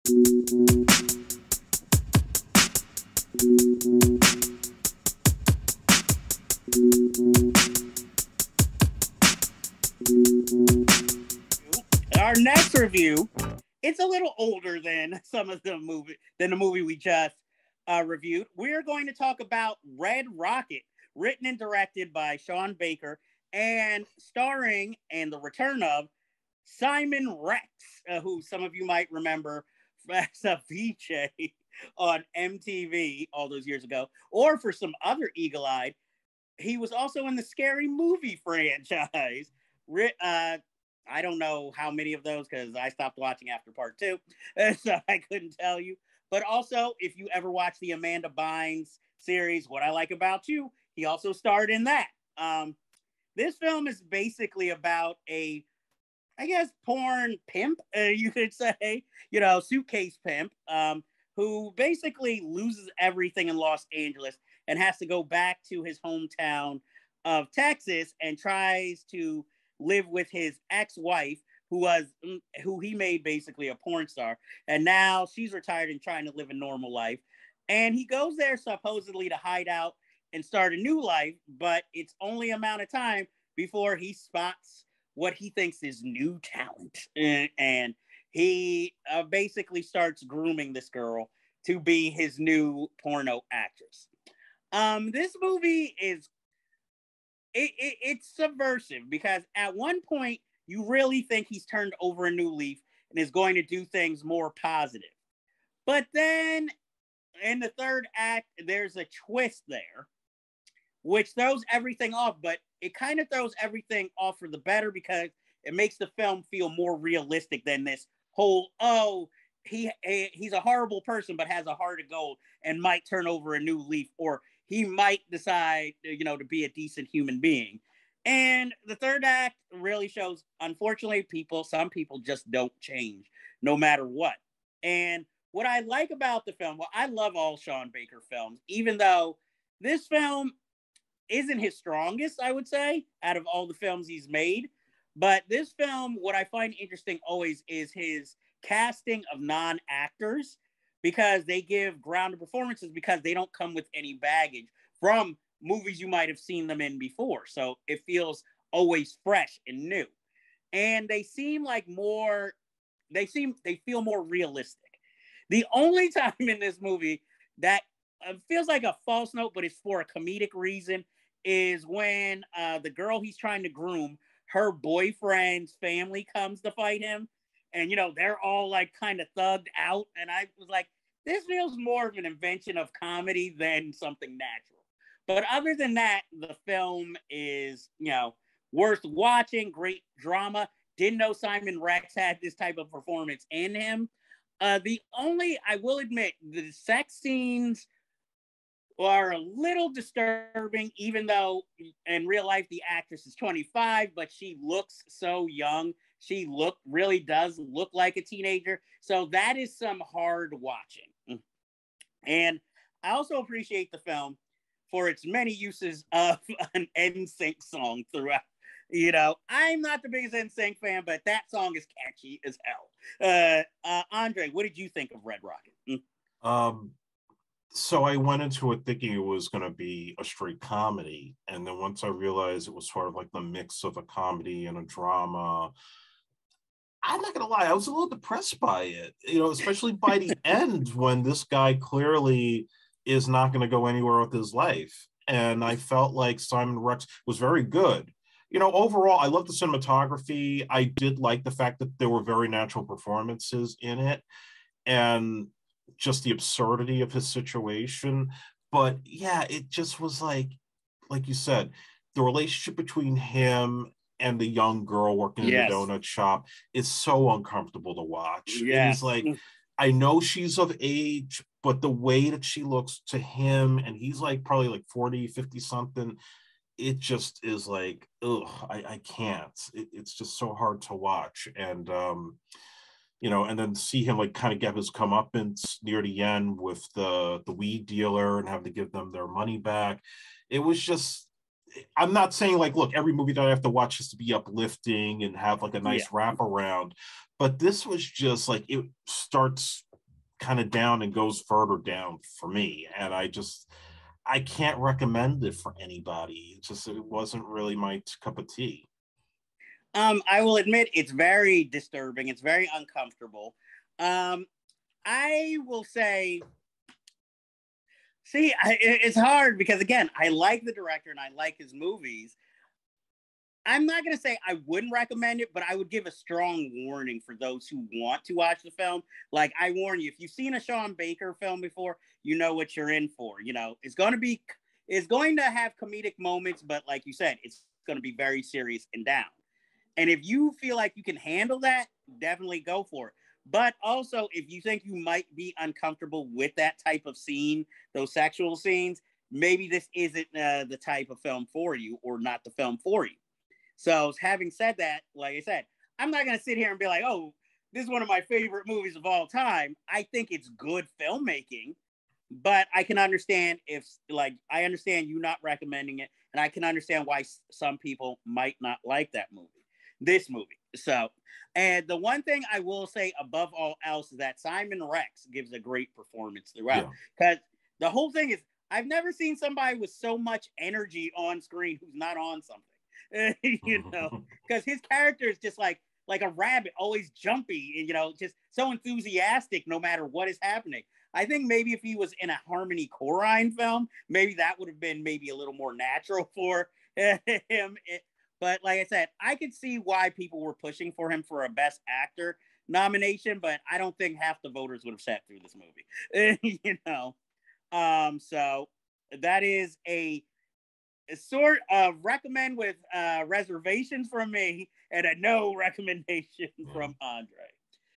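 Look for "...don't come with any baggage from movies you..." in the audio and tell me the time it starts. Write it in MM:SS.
02:33.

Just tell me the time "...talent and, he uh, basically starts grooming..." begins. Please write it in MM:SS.
01:26.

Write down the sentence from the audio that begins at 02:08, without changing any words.
And the third act really shows, unfortunately, people, some people just don't change no matter what.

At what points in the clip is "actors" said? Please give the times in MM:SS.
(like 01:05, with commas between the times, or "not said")
02:29, 06:41.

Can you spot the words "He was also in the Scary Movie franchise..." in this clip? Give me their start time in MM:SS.
00:36.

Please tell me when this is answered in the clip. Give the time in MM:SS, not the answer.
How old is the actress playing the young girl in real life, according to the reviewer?
03:23.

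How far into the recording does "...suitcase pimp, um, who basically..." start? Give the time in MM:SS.
00:59.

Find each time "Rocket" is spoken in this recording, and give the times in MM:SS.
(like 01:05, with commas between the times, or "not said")
00:20, 03:45.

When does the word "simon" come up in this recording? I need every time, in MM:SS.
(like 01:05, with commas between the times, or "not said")
00:26, 03:11, 04:06, 06:14.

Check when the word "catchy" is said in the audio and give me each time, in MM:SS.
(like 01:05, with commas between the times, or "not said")
03:42.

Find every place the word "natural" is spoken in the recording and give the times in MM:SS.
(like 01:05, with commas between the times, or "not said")
03:04, 04:12, 06:35.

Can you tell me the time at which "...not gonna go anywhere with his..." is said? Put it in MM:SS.
04:03.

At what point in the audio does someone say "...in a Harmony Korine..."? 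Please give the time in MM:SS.
06:32.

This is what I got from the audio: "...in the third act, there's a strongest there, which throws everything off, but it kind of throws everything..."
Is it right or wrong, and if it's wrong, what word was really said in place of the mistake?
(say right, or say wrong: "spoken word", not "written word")
wrong: "twist", not "strongest".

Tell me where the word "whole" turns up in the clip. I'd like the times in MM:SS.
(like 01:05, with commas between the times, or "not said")
01:58, 06:17.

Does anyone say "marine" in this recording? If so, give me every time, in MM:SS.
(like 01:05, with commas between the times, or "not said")
not said.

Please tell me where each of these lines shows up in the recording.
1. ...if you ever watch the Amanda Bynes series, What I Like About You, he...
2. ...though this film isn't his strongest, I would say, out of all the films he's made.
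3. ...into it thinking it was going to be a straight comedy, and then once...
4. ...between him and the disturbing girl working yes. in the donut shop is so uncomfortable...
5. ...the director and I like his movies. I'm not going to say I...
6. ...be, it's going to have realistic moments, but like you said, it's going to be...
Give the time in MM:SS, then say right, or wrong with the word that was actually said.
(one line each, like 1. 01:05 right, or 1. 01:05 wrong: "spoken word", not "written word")
1. 00:46 right
2. 02:18 right
3. 03:48 right
4. 04:22 wrong: "young", not "disturbing"
5. 05:20 right
6. 05:34 wrong: "comedic", not "realistic".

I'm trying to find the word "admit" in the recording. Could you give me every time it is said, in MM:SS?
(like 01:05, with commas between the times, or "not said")
03:15, 05:10.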